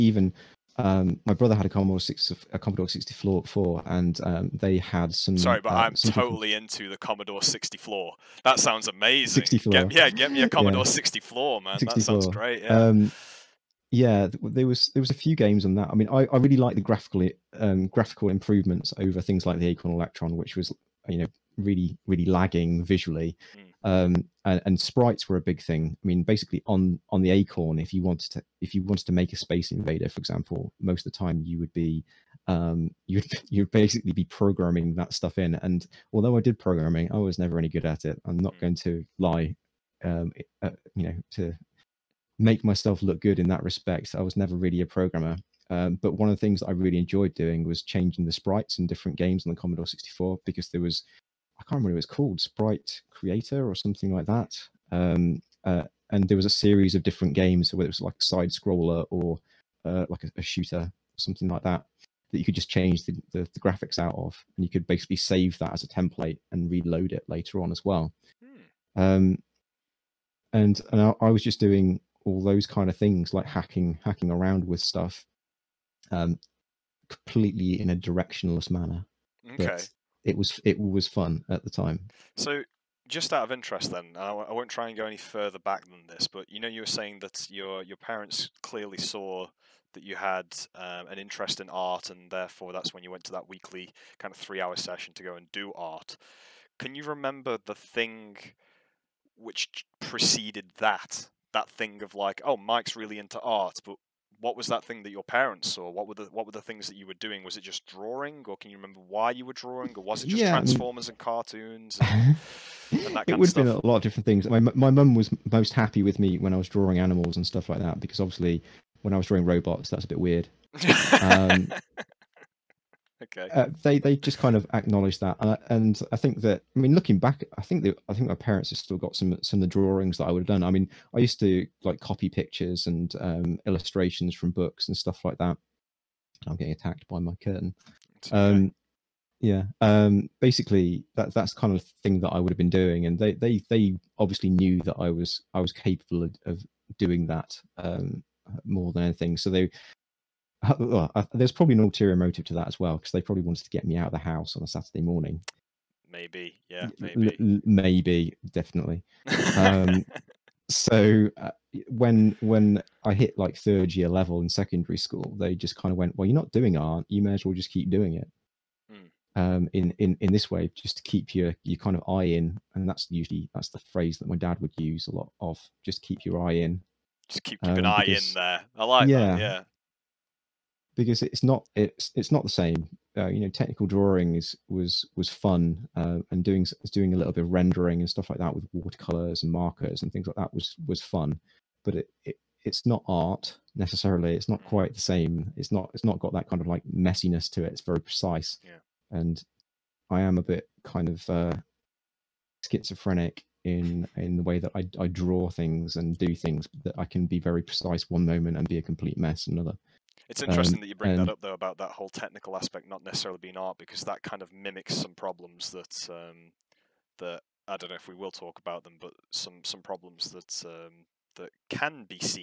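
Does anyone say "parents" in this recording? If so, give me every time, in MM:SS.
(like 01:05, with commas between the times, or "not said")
01:27, 01:45, 02:08.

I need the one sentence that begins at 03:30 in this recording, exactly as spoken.
It's um, interesting um, that you bring and...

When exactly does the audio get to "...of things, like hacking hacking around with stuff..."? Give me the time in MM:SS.
01:12.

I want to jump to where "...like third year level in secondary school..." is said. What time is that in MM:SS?
02:43.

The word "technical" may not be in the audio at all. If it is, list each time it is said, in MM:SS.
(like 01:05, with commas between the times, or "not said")
03:03, 03:32.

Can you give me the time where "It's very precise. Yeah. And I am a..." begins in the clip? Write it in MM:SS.
03:17.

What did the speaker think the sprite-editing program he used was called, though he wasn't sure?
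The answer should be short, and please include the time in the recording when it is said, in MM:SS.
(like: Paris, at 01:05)
Sprite Creator, at 00:52.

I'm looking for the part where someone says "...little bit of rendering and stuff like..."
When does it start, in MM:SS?
03:07.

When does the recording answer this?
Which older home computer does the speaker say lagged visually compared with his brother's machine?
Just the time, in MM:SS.
00:19.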